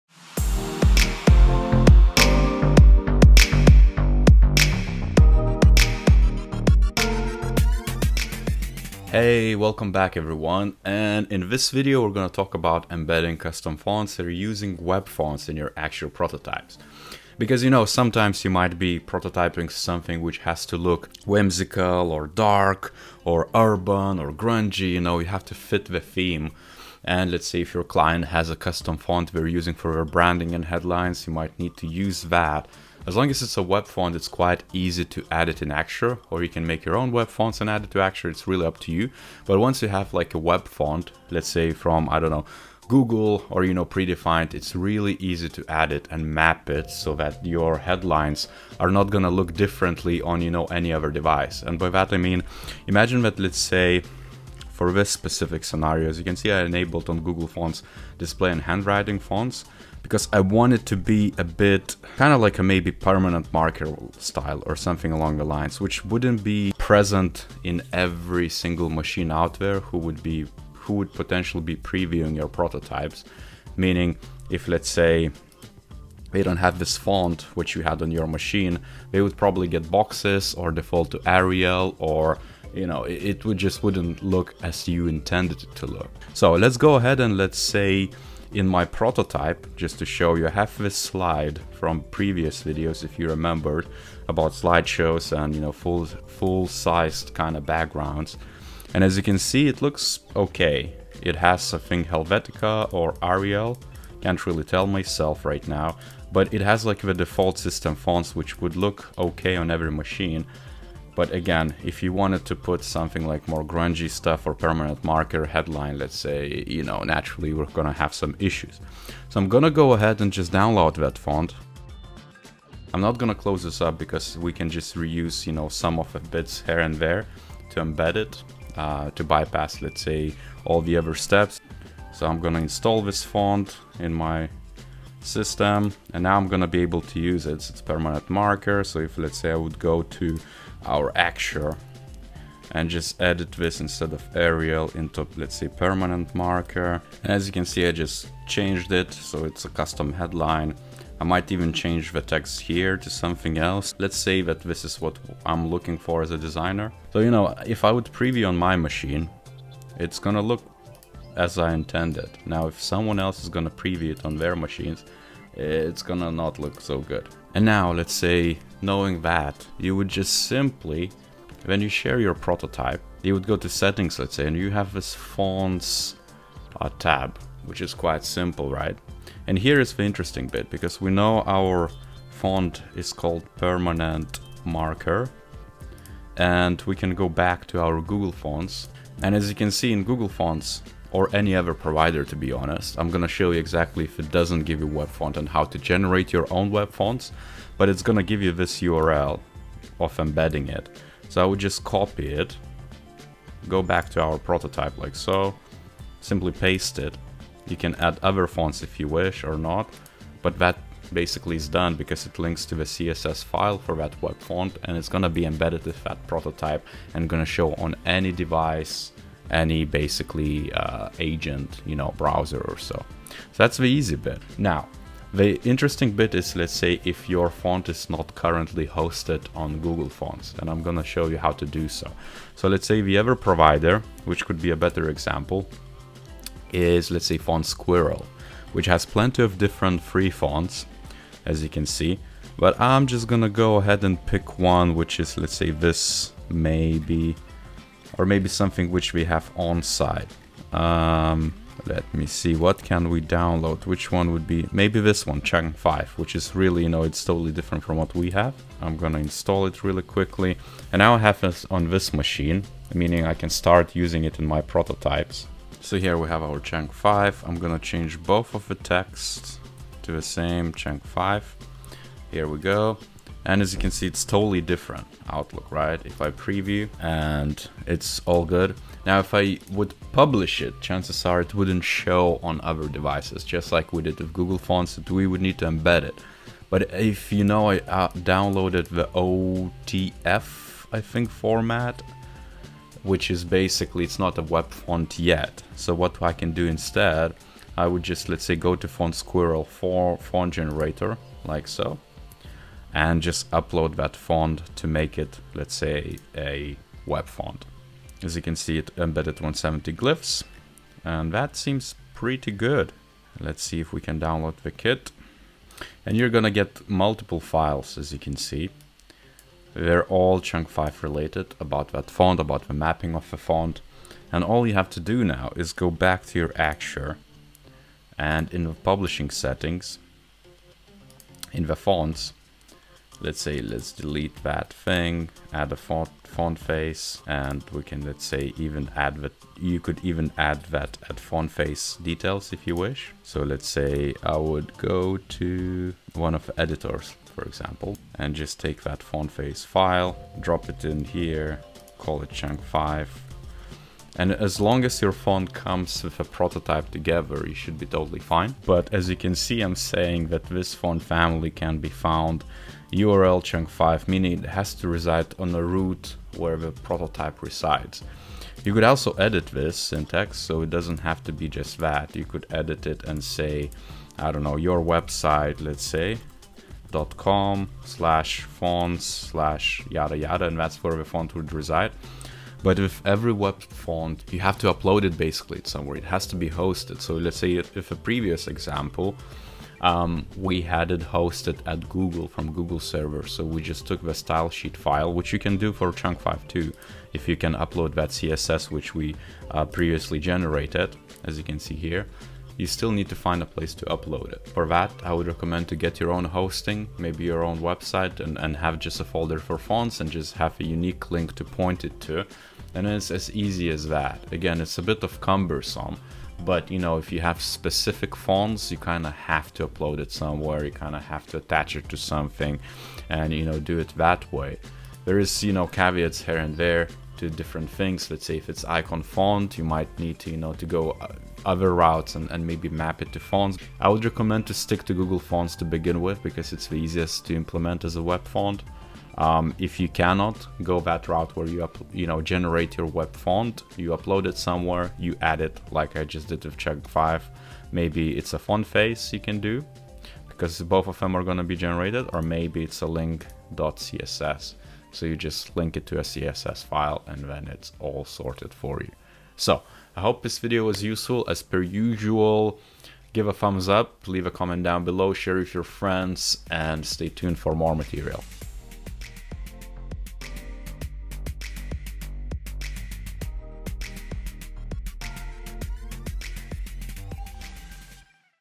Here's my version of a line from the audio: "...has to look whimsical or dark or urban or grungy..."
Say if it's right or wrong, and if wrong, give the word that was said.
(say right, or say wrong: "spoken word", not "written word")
right.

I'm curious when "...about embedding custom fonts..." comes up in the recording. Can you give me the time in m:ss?
0:12.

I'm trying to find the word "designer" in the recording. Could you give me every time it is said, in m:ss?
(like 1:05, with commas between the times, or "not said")
2:36.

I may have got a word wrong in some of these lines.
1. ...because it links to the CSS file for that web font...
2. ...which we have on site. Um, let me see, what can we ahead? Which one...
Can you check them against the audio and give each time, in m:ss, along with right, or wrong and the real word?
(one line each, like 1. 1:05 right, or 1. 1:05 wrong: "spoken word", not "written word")
1. 3:31 right
2. 4:08 wrong: "download", not "ahead".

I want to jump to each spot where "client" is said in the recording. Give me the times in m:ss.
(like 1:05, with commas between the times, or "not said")
0:27.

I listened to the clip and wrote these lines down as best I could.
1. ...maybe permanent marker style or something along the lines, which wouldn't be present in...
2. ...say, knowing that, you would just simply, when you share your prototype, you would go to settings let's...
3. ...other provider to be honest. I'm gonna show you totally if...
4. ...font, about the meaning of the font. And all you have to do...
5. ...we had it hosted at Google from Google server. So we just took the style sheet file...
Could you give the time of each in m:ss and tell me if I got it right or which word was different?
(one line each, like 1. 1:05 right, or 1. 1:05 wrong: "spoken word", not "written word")
1. 1:02 right
2. 2:48 right
3. 3:11 wrong: "exactly", not "totally"
4. 5:22 wrong: "mapping", not "meaning"
5. 6:30 right.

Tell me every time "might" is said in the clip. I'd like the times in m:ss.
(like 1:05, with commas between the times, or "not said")
0:18, 0:31, 2:31, 7:09.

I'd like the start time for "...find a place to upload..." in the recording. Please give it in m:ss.
6:43.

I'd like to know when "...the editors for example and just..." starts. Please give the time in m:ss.
5:46.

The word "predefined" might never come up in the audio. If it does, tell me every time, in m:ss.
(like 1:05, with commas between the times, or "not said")
0:43.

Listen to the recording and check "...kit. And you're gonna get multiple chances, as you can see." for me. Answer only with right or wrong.
wrong.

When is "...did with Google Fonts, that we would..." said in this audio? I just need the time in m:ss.
4:44.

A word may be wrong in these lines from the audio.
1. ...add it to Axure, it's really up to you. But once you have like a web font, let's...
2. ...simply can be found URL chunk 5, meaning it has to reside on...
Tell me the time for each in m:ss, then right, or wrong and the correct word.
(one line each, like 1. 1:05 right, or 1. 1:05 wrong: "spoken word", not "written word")
1. 0:37 right
2. 6:00 wrong: "family", not "simply".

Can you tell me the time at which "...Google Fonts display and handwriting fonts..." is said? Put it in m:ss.
0:57.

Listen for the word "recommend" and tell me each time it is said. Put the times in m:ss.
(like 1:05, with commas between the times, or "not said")
6:45, 7:14.